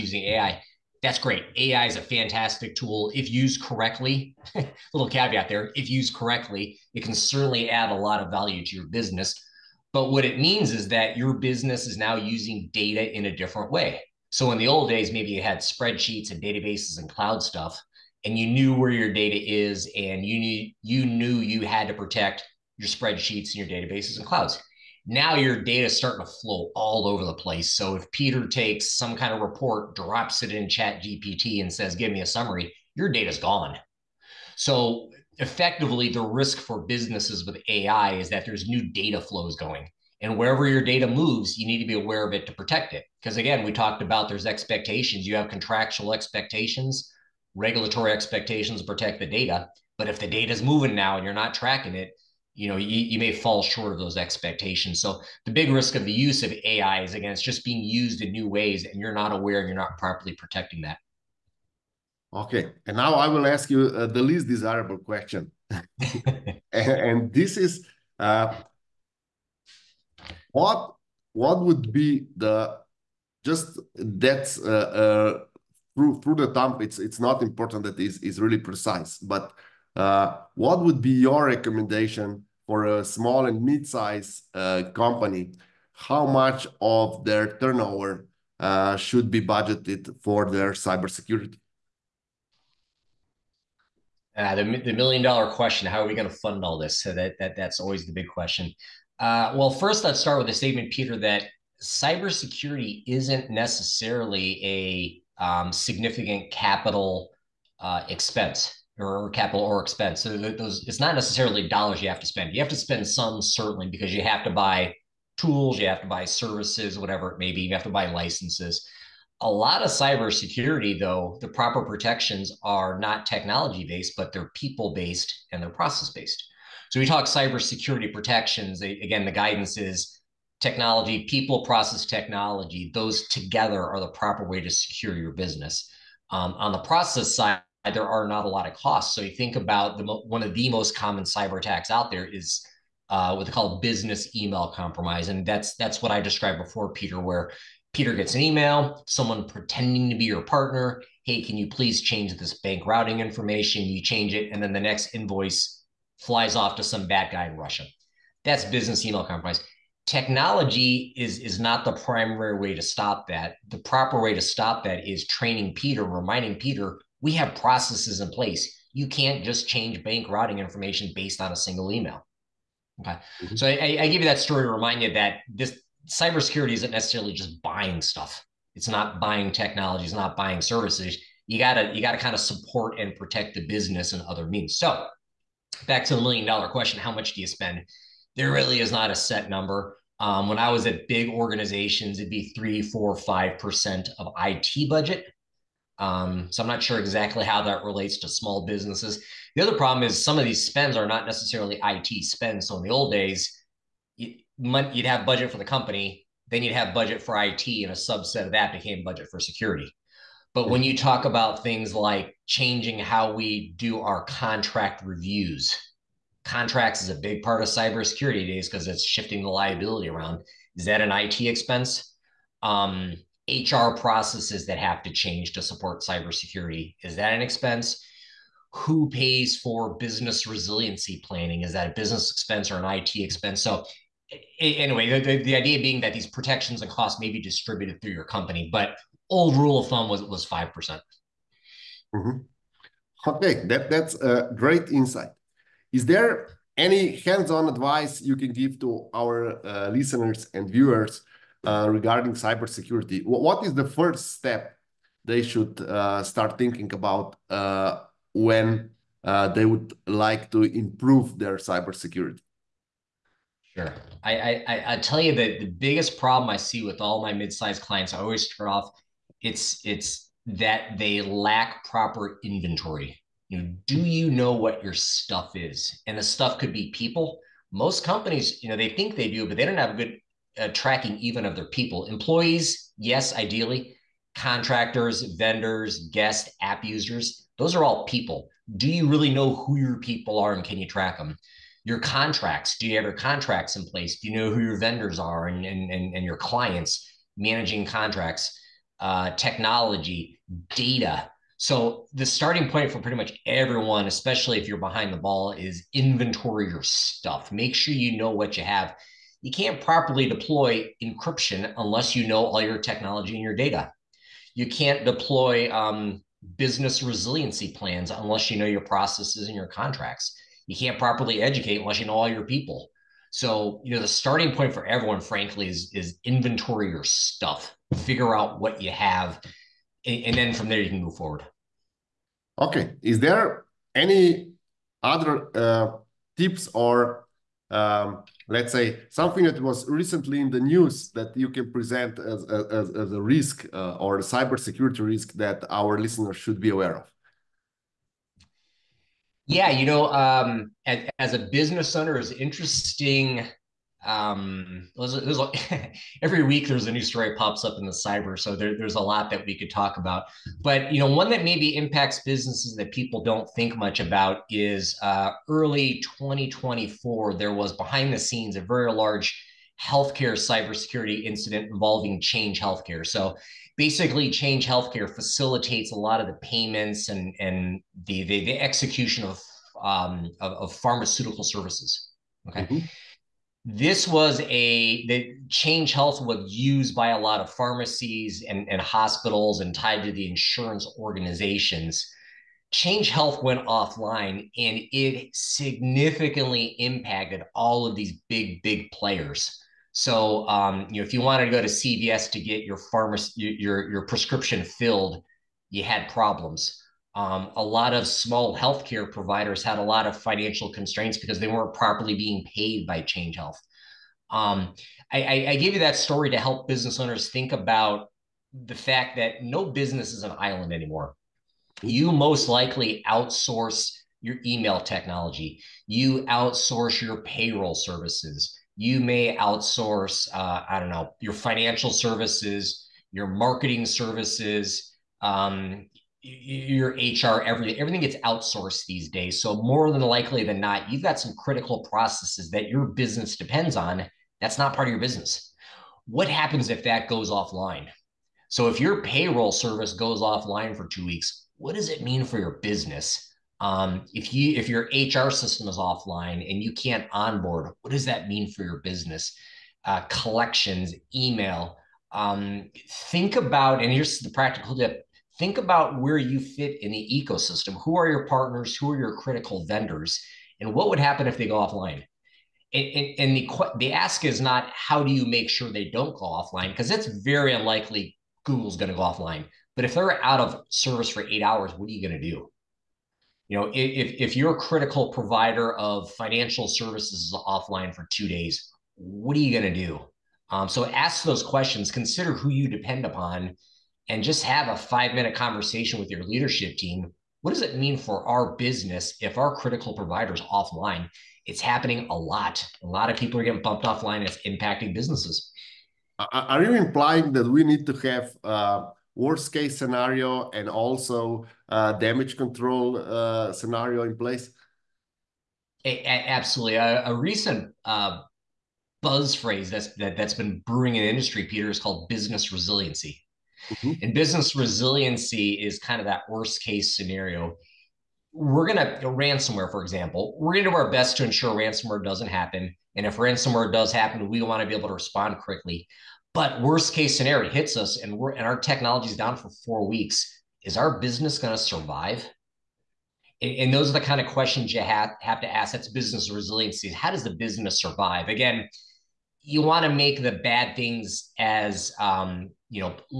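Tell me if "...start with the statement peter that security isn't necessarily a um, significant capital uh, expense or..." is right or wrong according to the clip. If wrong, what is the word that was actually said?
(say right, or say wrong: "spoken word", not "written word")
wrong: "cybersecurity", not "security".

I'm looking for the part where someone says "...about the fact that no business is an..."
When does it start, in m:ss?
6:57.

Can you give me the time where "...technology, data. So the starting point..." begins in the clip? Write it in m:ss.
4:59.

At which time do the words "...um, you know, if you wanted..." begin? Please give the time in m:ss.
6:40.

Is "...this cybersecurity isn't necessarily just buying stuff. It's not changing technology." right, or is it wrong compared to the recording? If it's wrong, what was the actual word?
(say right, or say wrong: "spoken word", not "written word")
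wrong: "buying", not "changing".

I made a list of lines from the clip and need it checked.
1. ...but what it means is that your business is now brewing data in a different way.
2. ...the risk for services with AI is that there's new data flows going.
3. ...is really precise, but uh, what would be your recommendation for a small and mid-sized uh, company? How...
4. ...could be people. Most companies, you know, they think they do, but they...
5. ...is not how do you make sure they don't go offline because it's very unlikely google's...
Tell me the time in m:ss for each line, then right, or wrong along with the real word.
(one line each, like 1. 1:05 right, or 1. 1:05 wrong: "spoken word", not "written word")
1. 0:09 wrong: "using", not "brewing"
2. 0:36 wrong: "businesses", not "services"
3. 1:18 right
4. 4:36 right
5. 7:54 right.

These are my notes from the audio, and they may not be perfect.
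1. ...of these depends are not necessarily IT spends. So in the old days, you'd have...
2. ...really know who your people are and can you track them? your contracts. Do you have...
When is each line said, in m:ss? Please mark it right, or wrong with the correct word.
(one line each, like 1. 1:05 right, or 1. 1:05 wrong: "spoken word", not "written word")
1. 3:20 wrong: "spends", not "depends"
2. 4:49 right.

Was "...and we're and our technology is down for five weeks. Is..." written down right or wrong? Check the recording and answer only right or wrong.
wrong.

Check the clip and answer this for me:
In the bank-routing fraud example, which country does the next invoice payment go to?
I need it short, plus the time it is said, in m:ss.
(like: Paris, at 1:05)
Russia, at 2:37.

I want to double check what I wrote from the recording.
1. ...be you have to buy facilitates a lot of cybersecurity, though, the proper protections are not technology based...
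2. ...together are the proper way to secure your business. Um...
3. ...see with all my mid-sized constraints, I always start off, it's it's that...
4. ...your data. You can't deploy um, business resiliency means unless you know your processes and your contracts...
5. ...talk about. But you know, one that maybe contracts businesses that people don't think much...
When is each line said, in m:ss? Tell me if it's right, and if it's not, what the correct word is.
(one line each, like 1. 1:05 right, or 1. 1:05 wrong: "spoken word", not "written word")
1. 1:57 wrong: "licenses", not "facilitates"
2. 2:13 right
3. 4:26 wrong: "clients", not "constraints"
4. 5:13 wrong: "plans", not "means"
5. 5:59 wrong: "impacts", not "contracts".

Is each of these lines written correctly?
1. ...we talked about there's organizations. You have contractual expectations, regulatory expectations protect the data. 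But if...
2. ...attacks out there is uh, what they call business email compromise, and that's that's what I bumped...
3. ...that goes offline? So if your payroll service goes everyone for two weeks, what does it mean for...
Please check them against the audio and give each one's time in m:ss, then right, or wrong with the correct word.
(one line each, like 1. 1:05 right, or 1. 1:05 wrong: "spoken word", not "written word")
1. 0:43 wrong: "expectations", not "organizations"
2. 2:21 wrong: "described", not "bumped"
3. 7:26 wrong: "offline", not "everyone".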